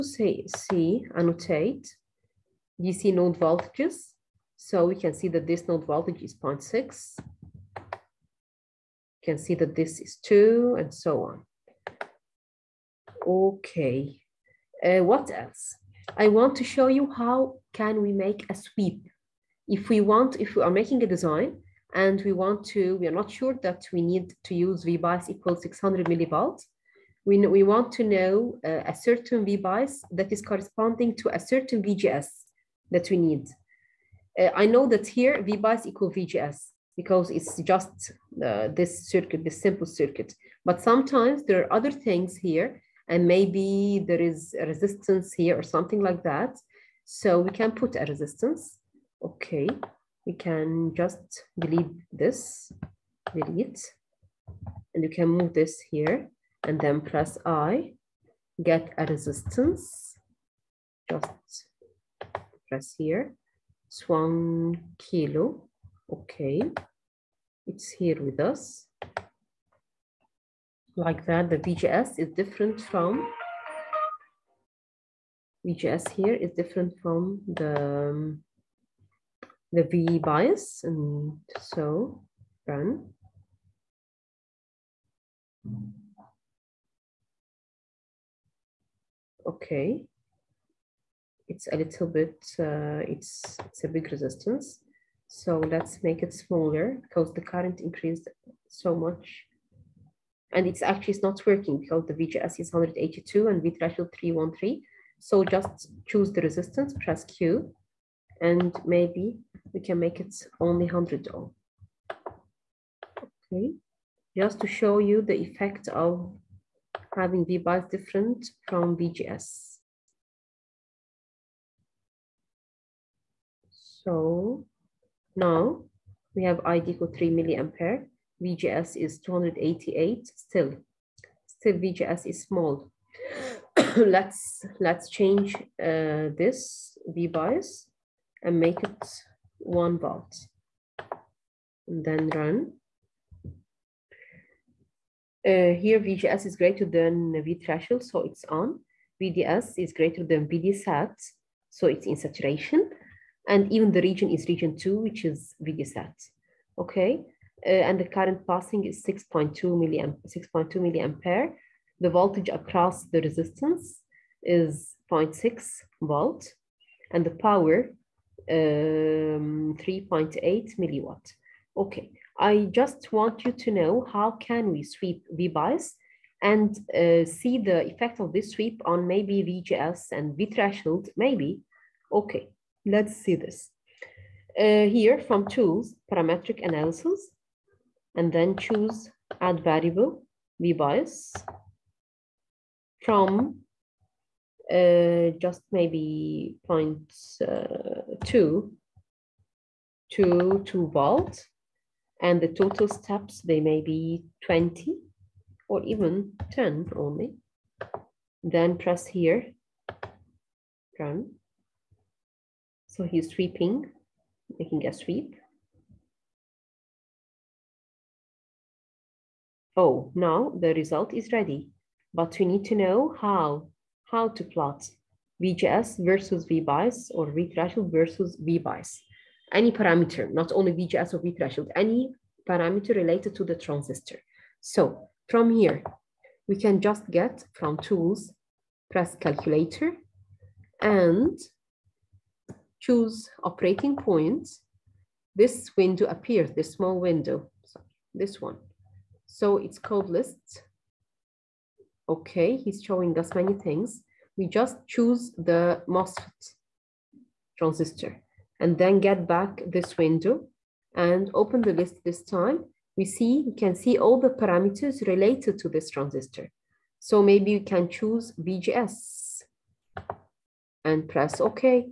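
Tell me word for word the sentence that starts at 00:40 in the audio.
But sometimes there are other things here and maybe there is a resistance here or something like that.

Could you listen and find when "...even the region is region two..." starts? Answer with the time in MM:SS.
02:33.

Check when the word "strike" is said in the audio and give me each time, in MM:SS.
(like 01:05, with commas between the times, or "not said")
not said.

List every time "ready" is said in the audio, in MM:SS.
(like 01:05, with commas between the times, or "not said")
03:41.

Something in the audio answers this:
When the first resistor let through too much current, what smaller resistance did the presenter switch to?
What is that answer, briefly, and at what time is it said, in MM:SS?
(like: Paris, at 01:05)
100, at 01:50.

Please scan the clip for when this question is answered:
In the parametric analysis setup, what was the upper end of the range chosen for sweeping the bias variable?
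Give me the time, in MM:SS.
03:20.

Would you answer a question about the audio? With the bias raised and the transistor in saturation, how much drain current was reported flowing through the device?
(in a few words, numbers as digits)
6.2 milliamperes.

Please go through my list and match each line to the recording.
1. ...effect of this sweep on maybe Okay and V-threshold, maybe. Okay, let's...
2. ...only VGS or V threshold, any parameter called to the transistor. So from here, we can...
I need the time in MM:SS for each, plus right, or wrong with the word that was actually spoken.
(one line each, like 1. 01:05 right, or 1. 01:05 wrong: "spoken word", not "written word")
1. 02:57 wrong: "VGS", not "Okay"
2. 03:50 wrong: "related", not "called".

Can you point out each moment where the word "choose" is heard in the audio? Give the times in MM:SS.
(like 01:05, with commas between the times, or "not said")
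01:46, 03:08, 04:02, 04:14, 04:27.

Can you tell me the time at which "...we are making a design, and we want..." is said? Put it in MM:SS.
00:20.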